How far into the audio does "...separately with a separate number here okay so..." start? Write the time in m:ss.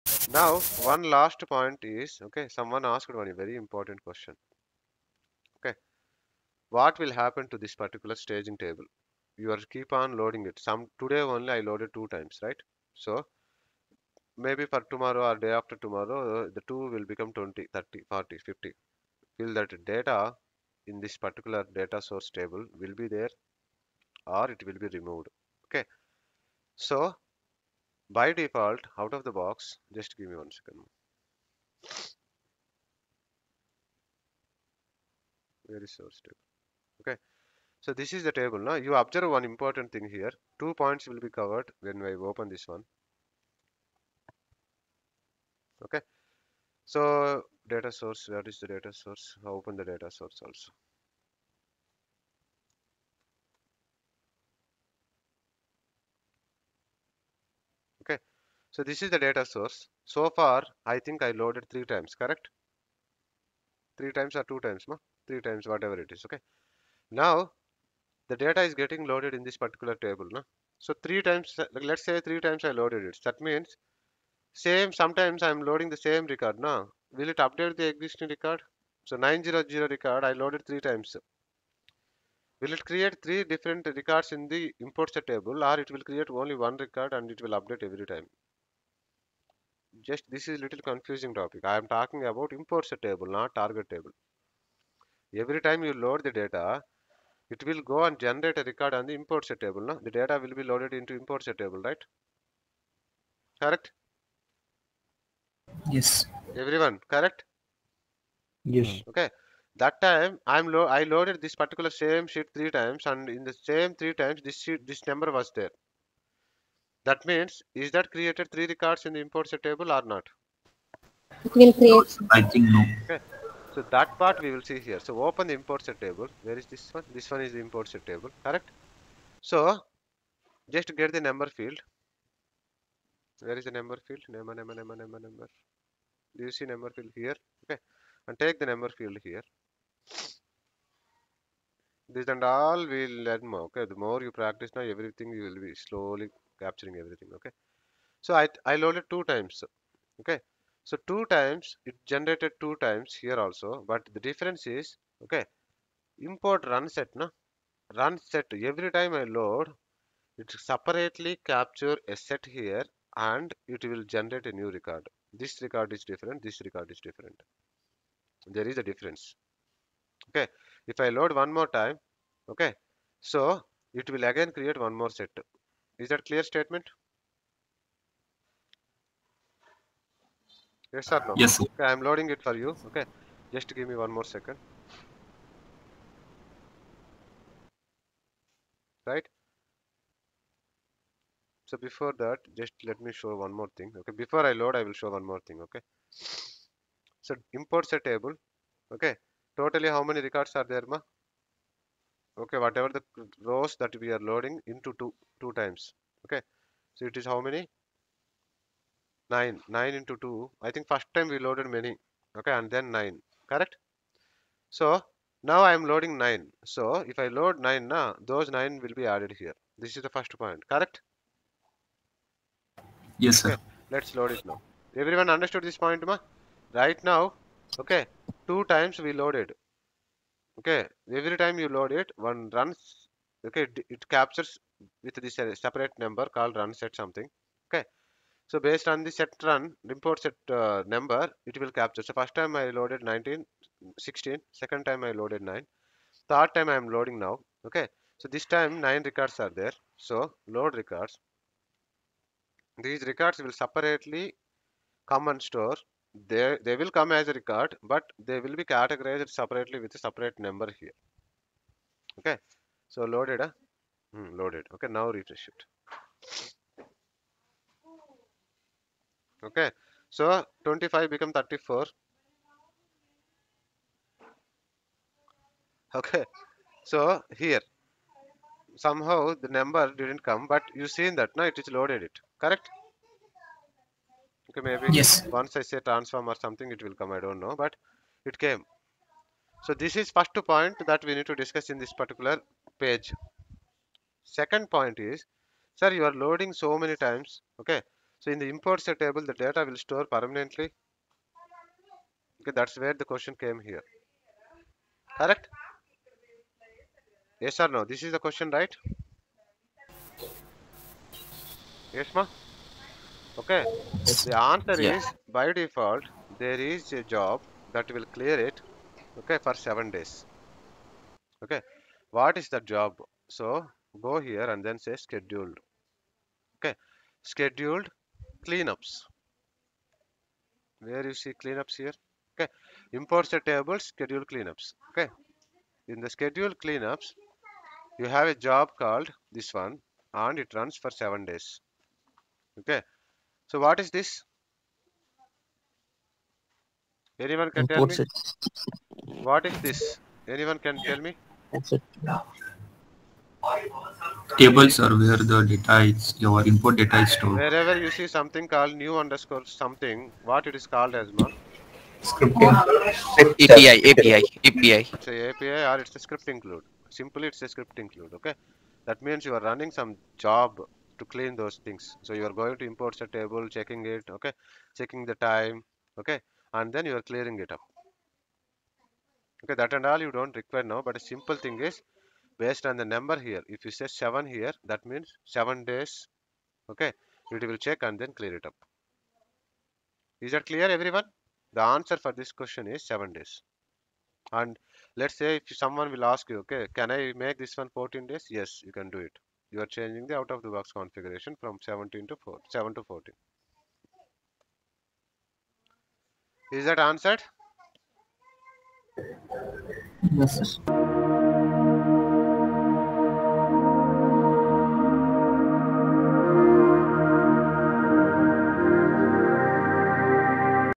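4:19.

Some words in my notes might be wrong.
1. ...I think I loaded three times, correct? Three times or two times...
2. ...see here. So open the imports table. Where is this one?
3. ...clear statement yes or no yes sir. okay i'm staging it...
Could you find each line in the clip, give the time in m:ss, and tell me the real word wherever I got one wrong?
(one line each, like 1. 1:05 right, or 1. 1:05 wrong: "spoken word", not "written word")
1. 1:00 right
2. 2:04 right
3. 2:56 wrong: "loading", not "staging".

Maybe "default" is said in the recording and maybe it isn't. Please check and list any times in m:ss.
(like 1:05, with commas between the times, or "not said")
0:28, 5:15.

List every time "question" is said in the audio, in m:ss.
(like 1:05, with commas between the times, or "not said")
0:04, 5:03, 5:08, 6:32.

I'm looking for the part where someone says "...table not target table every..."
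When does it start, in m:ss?
1:33.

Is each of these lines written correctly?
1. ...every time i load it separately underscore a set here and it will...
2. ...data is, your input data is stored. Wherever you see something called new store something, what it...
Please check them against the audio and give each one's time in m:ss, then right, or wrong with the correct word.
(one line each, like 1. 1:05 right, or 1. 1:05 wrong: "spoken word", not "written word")
1. 2:38 wrong: "capture", not "underscore"
2. 5:55 wrong: "underscore", not "store".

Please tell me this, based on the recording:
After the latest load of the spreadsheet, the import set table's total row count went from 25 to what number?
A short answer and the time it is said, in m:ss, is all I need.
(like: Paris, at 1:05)
34, at 4:31.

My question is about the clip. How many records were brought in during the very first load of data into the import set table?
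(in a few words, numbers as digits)
16.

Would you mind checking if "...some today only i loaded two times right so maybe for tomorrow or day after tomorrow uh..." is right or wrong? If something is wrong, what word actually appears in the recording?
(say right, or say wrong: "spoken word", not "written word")
right.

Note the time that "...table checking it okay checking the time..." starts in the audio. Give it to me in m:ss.
6:13.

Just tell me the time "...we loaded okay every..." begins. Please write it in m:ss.
3:49.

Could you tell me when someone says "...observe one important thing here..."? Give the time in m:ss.
0:39.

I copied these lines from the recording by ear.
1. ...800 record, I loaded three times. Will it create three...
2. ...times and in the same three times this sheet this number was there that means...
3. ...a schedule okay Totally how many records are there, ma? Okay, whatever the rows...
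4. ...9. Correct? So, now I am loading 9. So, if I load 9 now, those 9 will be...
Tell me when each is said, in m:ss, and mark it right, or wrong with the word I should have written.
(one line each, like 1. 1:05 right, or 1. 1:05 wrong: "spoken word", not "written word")
1. 1:19 wrong: "900", not "800"
2. 1:52 right
3. 3:17 wrong: "table", not "schedule"
4. 3:32 right.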